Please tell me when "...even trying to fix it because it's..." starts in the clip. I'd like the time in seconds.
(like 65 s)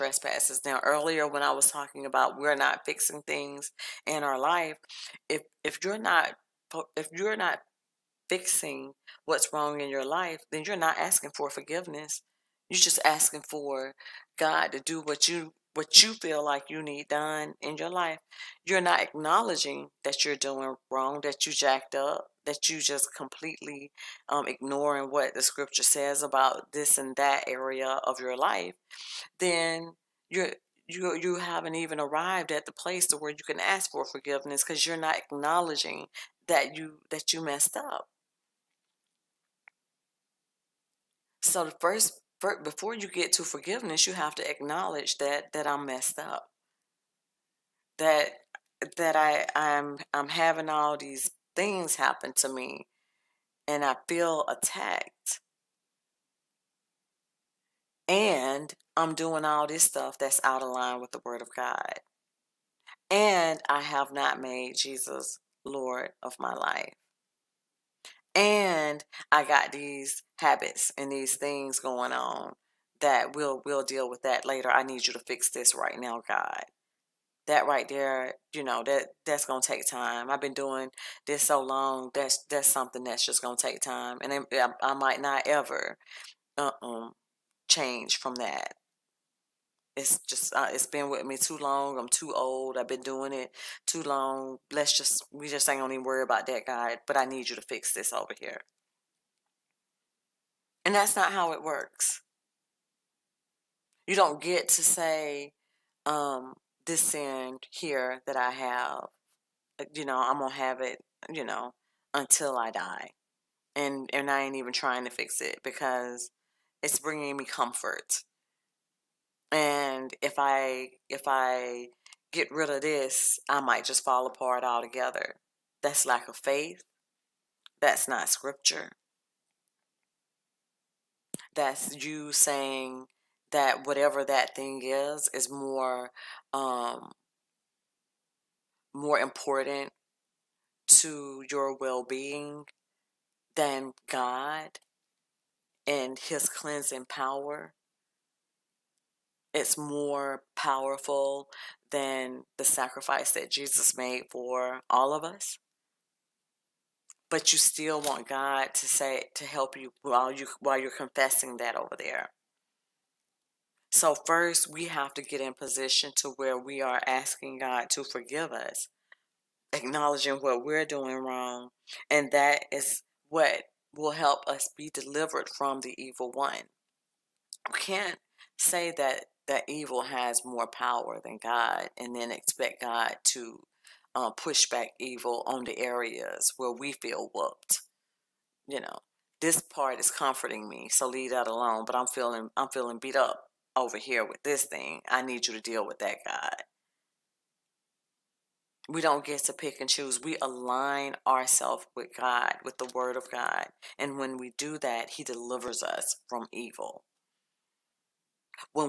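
114 s.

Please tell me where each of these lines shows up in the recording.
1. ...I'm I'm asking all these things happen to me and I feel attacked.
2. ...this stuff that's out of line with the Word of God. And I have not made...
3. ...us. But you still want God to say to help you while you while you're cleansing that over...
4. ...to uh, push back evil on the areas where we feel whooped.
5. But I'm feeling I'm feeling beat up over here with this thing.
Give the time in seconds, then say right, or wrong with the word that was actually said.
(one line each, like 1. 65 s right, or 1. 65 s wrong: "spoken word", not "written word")
1. 49 s wrong: "having", not "asking"
2. 59 s right
3. 155 s wrong: "confessing", not "cleansing"
4. 183 s right
5. 191 s right.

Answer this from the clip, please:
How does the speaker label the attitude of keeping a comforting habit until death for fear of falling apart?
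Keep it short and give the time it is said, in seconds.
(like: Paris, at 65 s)
Lack of faith, at 126 s.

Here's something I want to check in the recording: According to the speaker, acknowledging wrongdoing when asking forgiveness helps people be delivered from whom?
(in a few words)
The evil one.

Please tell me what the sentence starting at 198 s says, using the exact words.
We don't get to pick and choose.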